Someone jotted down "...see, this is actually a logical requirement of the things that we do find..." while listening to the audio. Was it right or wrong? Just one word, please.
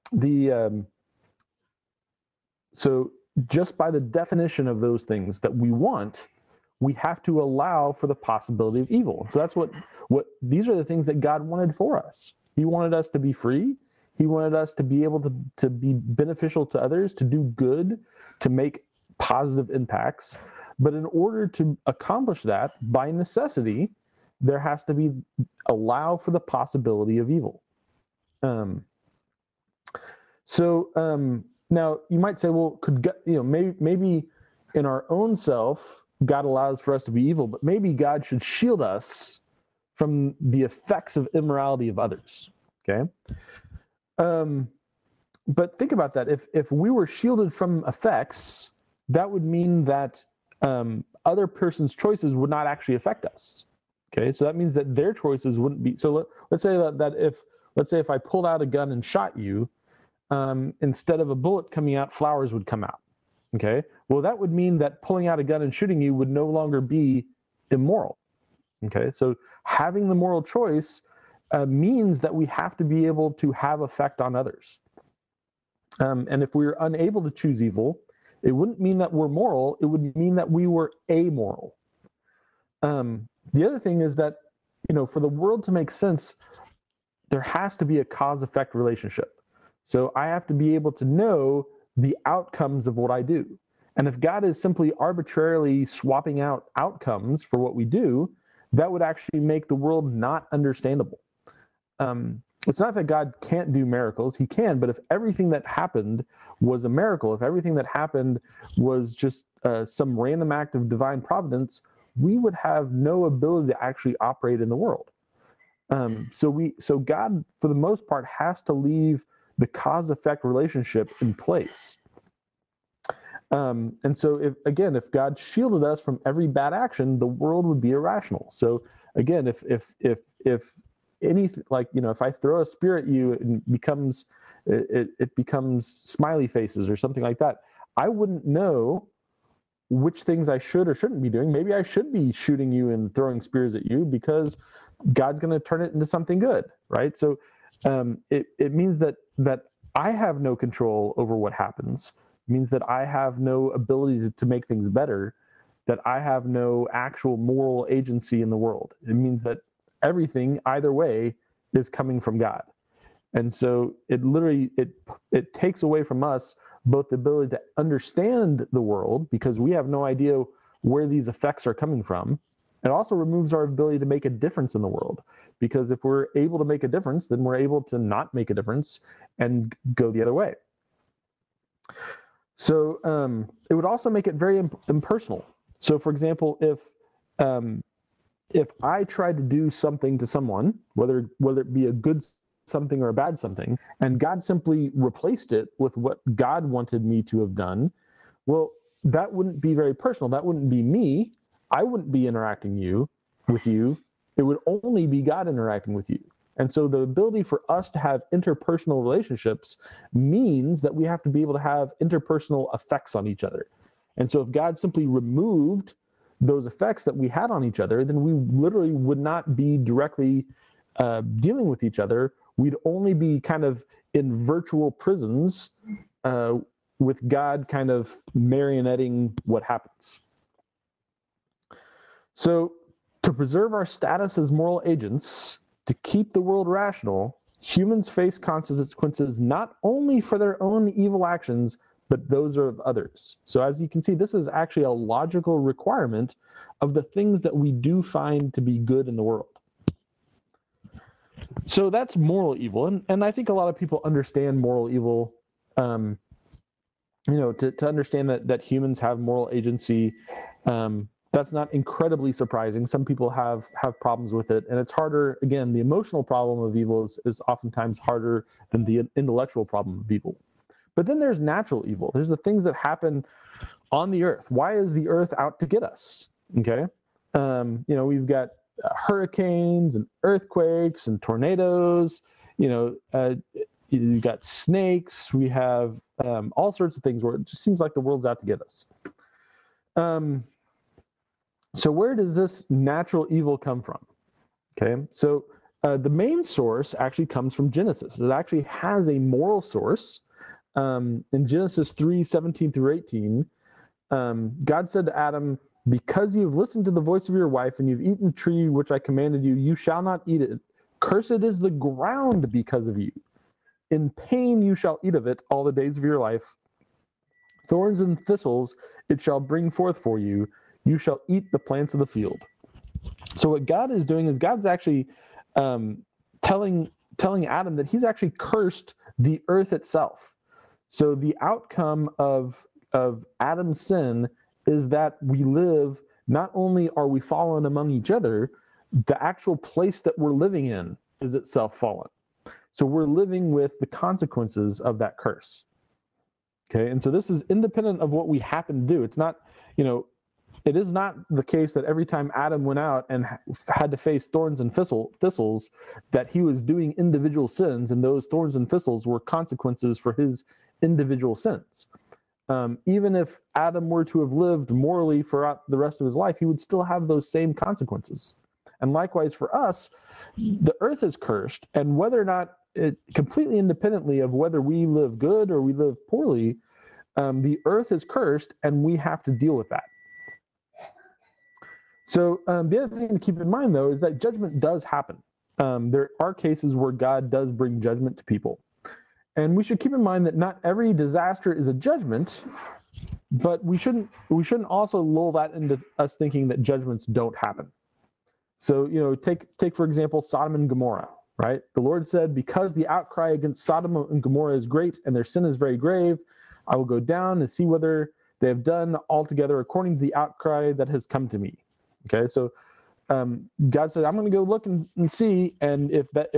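right.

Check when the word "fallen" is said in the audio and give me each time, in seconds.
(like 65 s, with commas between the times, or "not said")
337 s, 341 s.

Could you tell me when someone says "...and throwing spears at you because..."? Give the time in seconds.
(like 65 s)
142 s.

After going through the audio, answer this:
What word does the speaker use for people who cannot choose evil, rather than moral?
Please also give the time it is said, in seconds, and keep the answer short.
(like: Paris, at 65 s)
Amoral, at 81 s.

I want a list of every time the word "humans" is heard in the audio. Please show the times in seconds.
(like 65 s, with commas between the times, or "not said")
237 s, 258 s.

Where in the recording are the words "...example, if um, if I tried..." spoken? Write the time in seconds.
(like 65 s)
186 s.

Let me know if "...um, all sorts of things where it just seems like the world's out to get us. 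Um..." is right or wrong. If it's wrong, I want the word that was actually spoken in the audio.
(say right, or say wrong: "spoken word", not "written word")
right.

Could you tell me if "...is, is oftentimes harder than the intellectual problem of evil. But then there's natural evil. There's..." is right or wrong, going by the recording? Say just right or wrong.
right.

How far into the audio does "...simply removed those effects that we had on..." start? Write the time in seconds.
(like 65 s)
214 s.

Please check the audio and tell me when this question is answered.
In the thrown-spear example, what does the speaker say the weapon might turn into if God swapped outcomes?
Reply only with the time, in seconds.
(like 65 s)
135 s.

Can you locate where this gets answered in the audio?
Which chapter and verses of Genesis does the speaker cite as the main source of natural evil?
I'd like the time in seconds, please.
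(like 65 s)
301 s.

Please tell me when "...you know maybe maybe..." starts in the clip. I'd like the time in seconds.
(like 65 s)
33 s.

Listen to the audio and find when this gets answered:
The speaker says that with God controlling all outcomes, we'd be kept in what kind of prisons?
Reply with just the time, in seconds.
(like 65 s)
224 s.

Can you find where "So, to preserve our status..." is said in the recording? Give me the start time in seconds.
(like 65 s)
232 s.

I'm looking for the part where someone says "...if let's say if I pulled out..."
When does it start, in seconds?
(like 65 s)
57 s.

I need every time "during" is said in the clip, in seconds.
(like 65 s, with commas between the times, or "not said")
not said.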